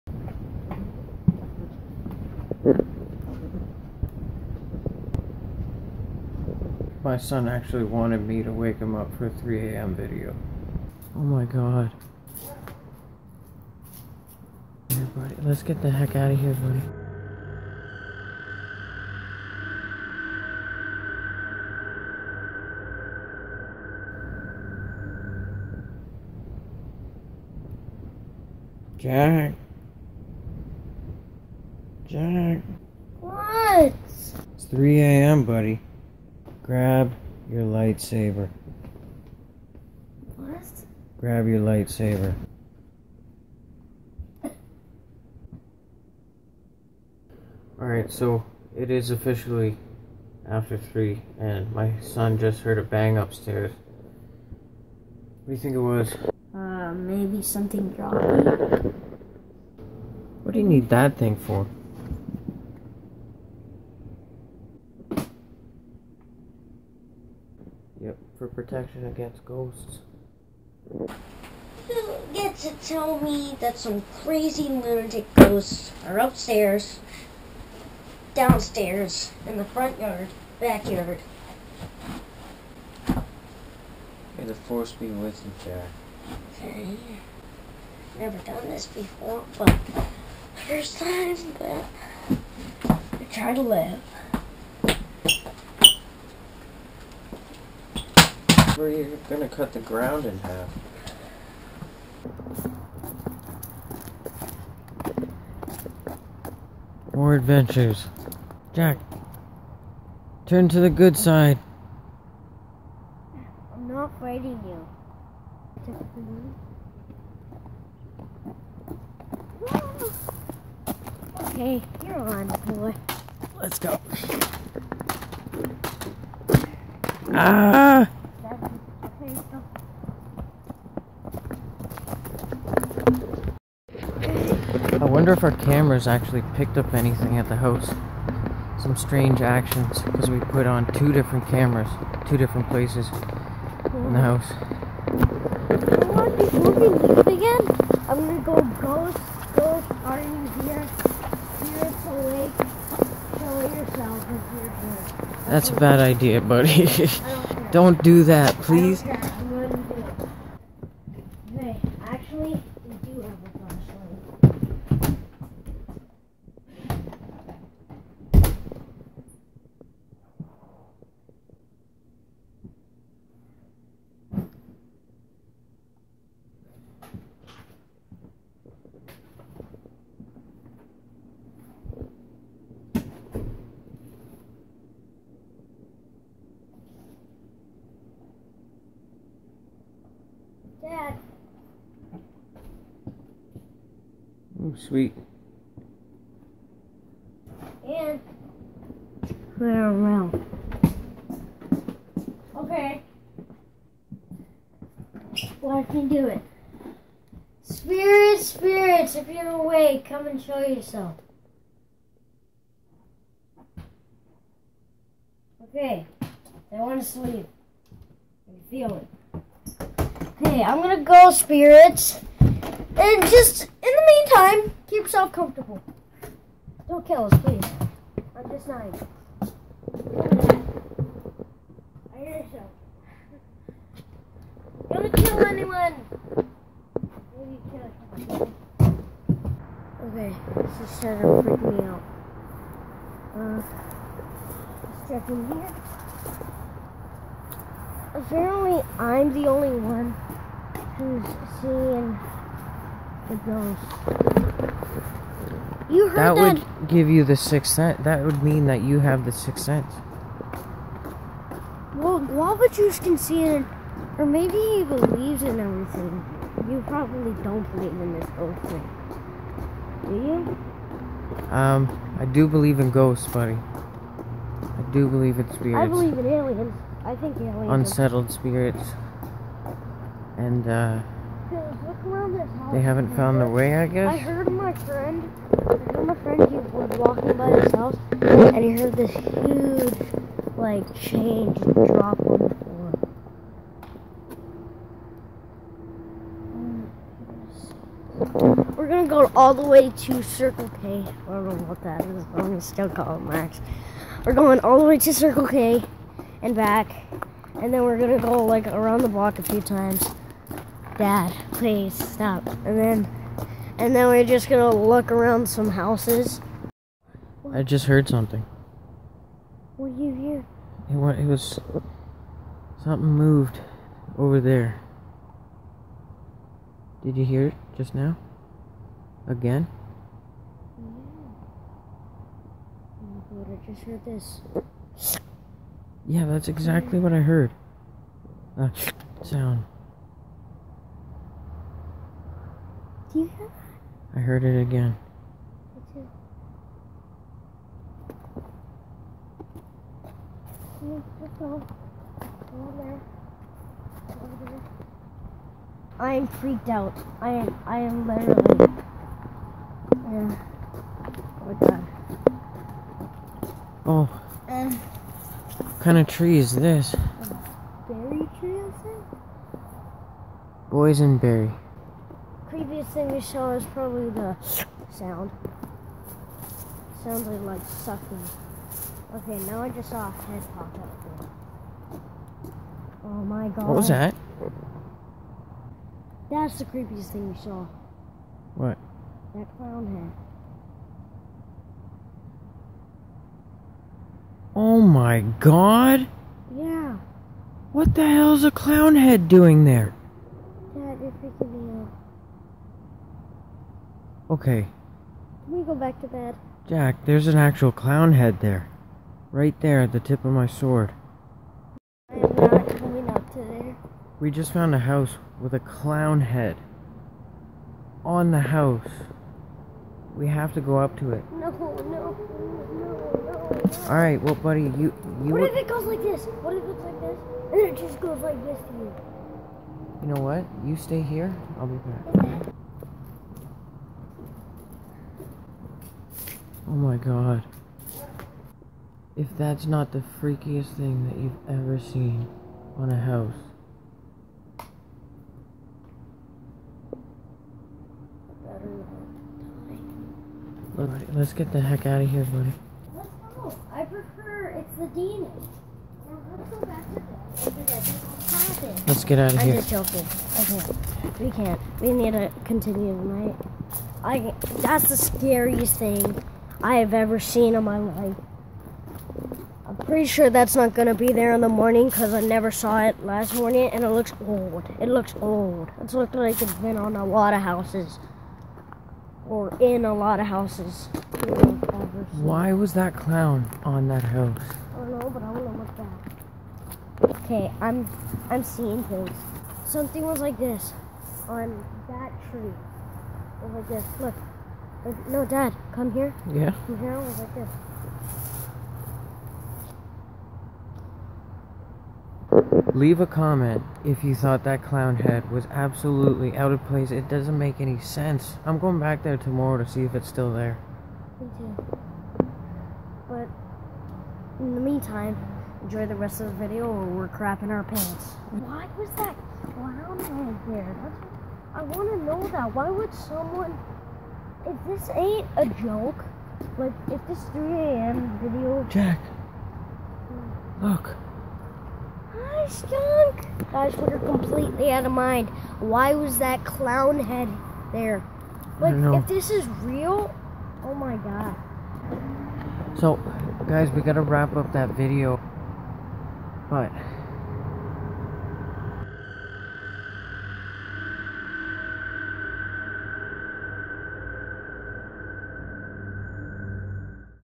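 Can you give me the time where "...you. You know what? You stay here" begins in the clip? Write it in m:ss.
7:08.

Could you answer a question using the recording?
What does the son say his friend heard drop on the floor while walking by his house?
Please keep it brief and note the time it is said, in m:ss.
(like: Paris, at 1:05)
Change, at 4:50.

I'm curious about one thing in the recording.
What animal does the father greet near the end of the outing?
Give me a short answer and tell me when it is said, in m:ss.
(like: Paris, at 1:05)
Skunk, at 8:52.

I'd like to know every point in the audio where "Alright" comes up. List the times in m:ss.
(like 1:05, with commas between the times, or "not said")
0:47, 7:03, 7:30.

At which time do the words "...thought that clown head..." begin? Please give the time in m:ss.
8:24.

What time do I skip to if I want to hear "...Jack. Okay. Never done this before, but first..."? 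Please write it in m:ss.
1:25.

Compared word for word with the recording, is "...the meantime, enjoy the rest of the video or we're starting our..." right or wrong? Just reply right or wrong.
wrong.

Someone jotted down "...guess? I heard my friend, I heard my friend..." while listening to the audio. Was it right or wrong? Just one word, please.
right.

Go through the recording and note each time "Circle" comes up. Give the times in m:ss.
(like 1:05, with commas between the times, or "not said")
5:00, 5:05.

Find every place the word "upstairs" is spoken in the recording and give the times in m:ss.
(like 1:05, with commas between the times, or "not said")
0:53, 1:16.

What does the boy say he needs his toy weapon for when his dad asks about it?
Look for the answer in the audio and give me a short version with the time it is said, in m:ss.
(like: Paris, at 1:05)
Protection against ghosts, at 1:08.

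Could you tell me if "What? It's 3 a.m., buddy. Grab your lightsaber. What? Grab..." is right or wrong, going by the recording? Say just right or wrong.
right.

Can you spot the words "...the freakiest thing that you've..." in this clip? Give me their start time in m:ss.
7:19.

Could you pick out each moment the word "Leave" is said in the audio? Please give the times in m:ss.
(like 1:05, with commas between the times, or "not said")
8:22.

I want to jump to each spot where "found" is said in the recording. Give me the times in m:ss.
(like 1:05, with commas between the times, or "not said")
4:43, 6:54.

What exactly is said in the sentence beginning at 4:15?
You heard that, that would give you the sixth sense.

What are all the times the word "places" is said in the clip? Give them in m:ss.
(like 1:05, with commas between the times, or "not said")
2:22, 8:26.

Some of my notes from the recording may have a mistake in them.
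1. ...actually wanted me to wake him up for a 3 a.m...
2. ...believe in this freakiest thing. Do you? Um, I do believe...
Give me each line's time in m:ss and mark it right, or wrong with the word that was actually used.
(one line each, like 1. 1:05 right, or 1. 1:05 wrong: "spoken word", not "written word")
1. 0:07 right
2. 4:27 wrong: "ghost", not "freakiest".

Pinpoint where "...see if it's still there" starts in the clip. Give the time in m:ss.
8:29.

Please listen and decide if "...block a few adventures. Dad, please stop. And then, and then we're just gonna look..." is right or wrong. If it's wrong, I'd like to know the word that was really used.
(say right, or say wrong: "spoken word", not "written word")
wrong: "times", not "adventures".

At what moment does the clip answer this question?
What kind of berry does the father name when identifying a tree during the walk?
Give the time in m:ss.
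6:10.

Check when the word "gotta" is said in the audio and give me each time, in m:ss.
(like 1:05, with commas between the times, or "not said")
9:03.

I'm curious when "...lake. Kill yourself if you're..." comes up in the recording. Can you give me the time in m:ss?
2:32.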